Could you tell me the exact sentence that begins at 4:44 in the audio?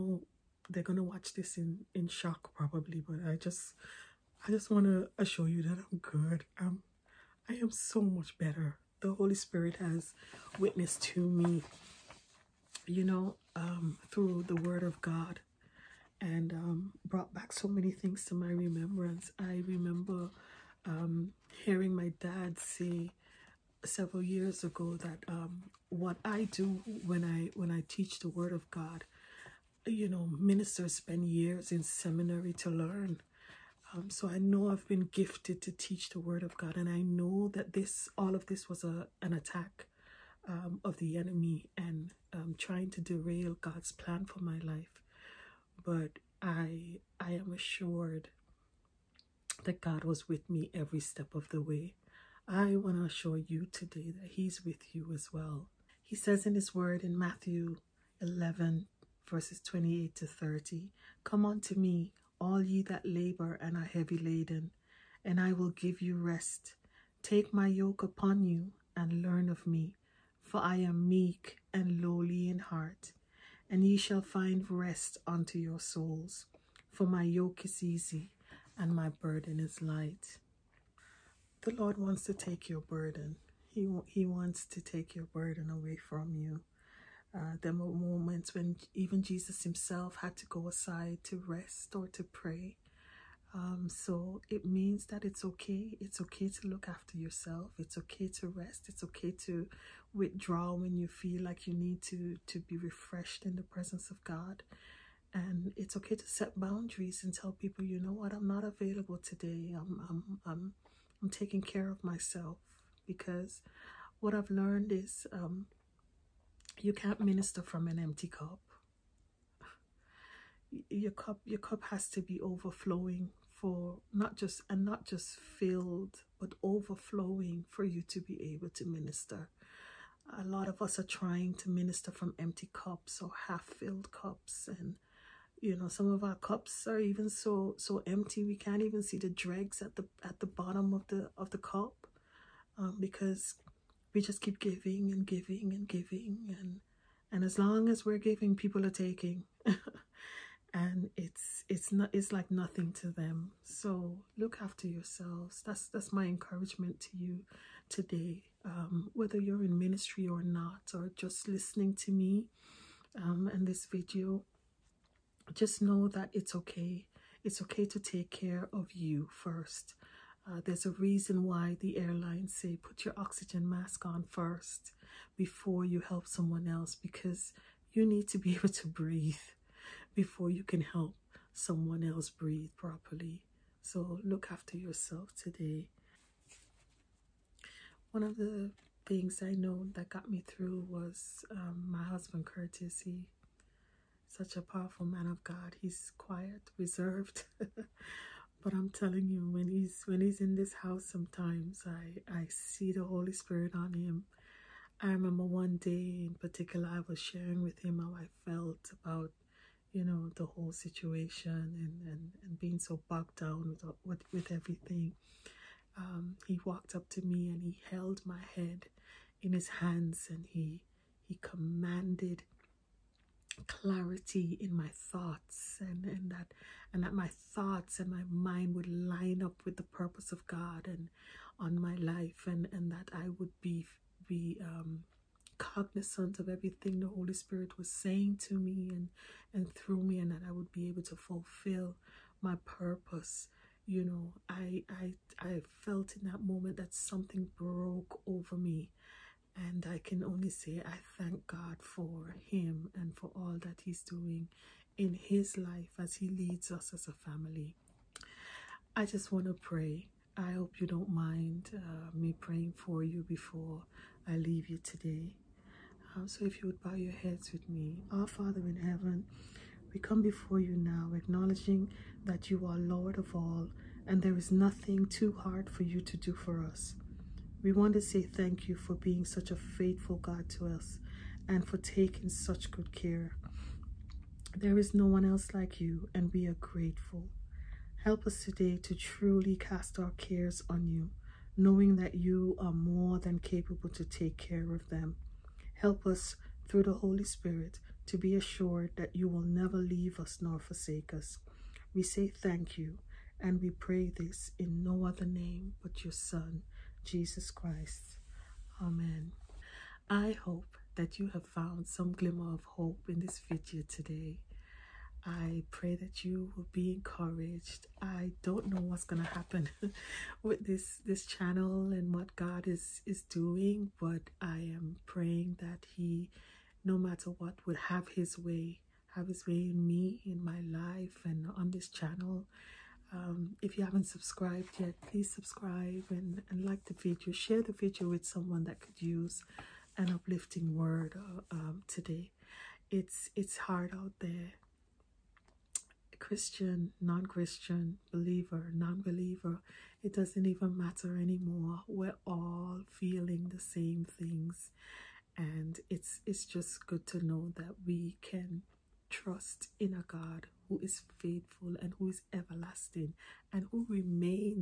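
There is no one else like you, and we are grateful.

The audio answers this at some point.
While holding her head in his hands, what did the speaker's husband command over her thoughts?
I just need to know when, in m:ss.
3:43.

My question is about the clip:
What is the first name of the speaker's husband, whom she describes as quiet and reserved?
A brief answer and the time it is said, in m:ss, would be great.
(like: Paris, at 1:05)
Curtis, at 3:12.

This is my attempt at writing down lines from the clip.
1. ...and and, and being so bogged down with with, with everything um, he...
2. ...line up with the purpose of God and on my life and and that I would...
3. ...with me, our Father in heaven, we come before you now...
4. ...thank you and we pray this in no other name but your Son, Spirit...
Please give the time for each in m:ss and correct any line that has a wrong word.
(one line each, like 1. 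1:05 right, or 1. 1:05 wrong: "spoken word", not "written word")
1. 3:31 right
2. 3:48 right
3. 4:27 right
4. 5:02 wrong: "Jesus", not "Spirit".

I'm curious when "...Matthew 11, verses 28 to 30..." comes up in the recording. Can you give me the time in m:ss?
0:57.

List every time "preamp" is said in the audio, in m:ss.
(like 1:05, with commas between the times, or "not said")
not said.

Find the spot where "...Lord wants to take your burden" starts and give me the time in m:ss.
1:21.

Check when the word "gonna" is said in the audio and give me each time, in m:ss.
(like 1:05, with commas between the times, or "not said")
0:00, 5:19.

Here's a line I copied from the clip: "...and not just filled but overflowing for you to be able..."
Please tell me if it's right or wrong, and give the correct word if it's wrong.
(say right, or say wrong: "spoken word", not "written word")
right.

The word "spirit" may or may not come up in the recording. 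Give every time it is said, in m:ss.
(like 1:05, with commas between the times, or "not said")
0:09, 3:23, 3:57, 4:57.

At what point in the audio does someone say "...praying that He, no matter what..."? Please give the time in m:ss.
5:25.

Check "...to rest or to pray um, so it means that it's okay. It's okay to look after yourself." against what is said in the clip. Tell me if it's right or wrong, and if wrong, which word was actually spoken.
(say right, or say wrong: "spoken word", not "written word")
right.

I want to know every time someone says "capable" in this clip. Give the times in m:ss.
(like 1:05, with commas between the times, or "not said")
4:53.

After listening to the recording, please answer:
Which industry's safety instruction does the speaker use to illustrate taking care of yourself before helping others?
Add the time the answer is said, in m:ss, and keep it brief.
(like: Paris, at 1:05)
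Airlines, at 2:51.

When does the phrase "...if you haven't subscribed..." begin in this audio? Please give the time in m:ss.
5:33.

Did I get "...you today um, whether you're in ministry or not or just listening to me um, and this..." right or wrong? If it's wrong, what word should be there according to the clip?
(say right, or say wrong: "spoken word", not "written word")
right.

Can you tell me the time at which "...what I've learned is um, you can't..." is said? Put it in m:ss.
1:54.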